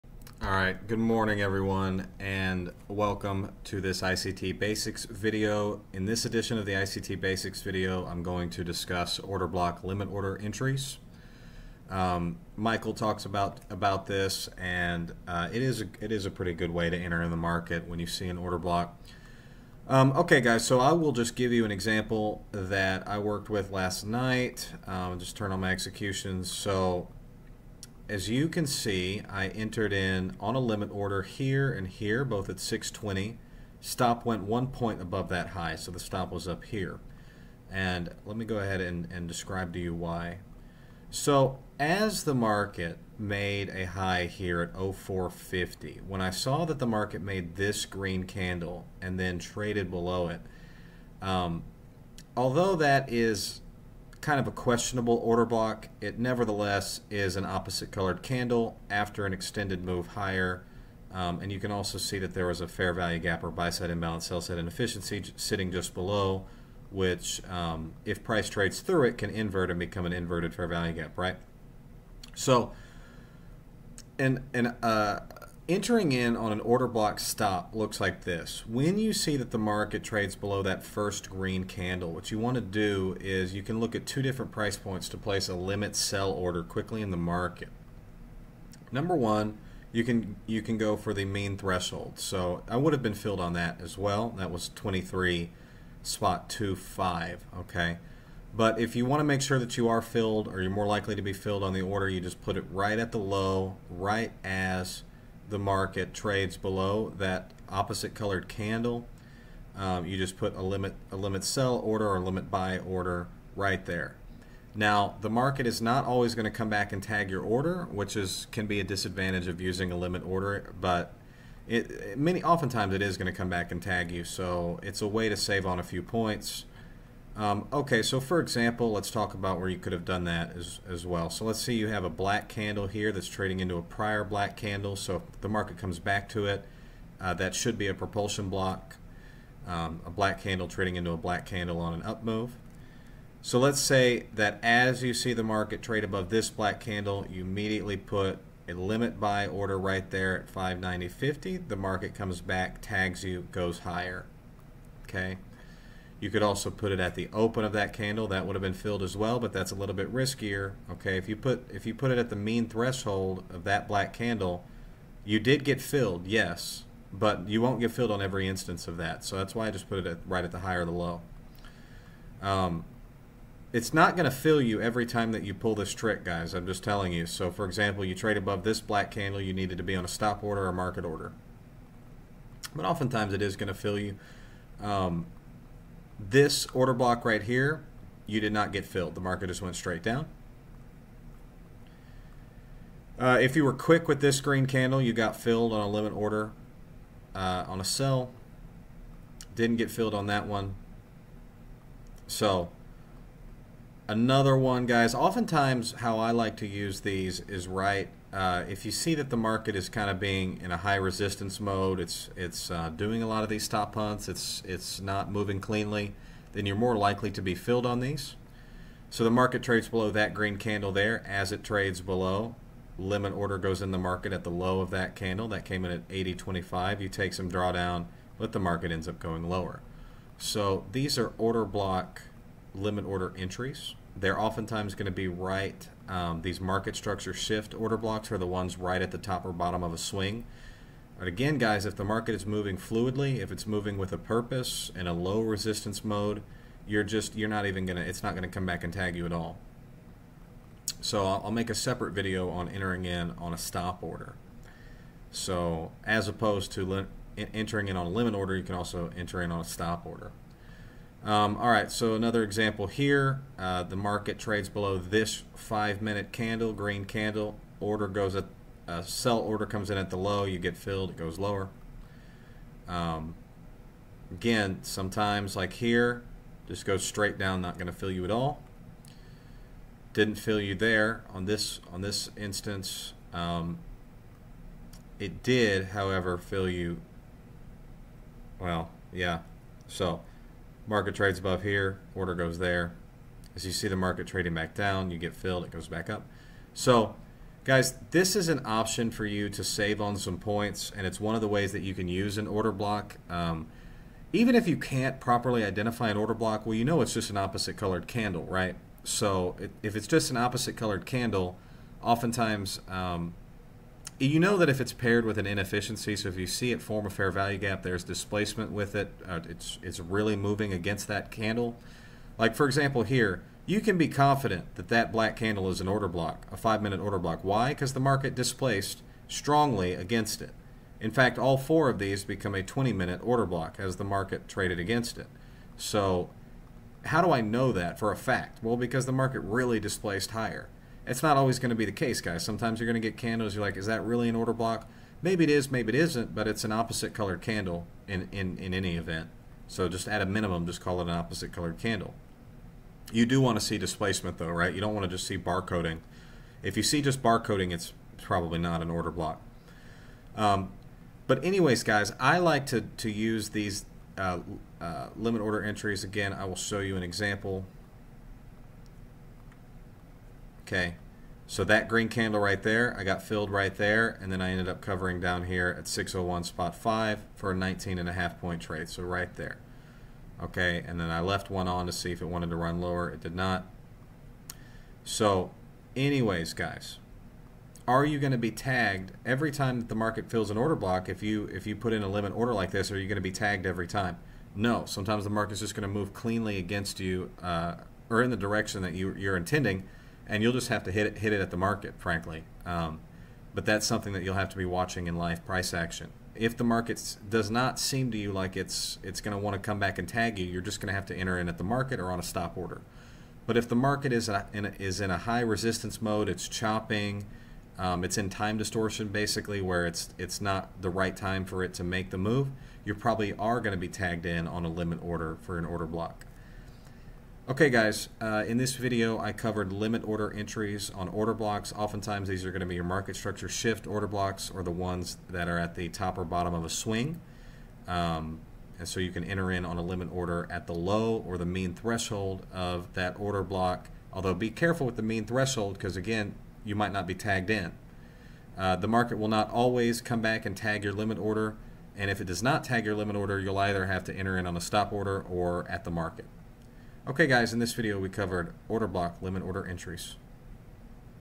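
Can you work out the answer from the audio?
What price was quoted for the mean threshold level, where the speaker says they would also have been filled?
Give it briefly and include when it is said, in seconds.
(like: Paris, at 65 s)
23.25, at 94 s.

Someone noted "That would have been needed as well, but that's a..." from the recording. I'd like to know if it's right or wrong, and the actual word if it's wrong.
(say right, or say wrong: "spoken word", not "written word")
wrong: "filled", not "needed".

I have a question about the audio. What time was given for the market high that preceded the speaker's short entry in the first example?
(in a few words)
04:50.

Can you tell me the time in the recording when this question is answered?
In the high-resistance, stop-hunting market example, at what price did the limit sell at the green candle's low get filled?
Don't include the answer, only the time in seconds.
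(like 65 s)
226 s.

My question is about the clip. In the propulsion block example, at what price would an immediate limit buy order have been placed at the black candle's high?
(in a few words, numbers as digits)
590.50.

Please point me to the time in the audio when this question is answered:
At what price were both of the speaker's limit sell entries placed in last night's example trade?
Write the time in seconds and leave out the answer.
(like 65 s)
32 s.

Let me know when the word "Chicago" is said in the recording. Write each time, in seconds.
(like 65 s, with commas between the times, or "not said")
not said.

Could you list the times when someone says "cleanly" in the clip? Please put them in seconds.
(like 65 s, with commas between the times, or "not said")
215 s, 396 s.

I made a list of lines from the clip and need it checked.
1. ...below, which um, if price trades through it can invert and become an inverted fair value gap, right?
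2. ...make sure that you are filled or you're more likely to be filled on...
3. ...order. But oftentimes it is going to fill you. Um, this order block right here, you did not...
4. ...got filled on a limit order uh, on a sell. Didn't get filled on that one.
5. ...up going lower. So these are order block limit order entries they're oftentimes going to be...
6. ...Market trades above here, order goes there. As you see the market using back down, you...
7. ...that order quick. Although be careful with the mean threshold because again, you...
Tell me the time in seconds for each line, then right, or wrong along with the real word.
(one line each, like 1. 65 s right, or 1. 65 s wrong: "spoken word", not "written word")
1. 65 s right
2. 99 s right
3. 181 s right
4. 195 s right
5. 229 s right
6. 290 s wrong: "trading", not "using"
7. 442 s wrong: "block", not "quick".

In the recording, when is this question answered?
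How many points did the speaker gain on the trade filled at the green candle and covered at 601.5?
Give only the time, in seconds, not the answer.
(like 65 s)
377 s.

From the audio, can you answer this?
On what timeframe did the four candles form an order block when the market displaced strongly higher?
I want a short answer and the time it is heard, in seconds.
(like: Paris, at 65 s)
20 minute, at 332 s.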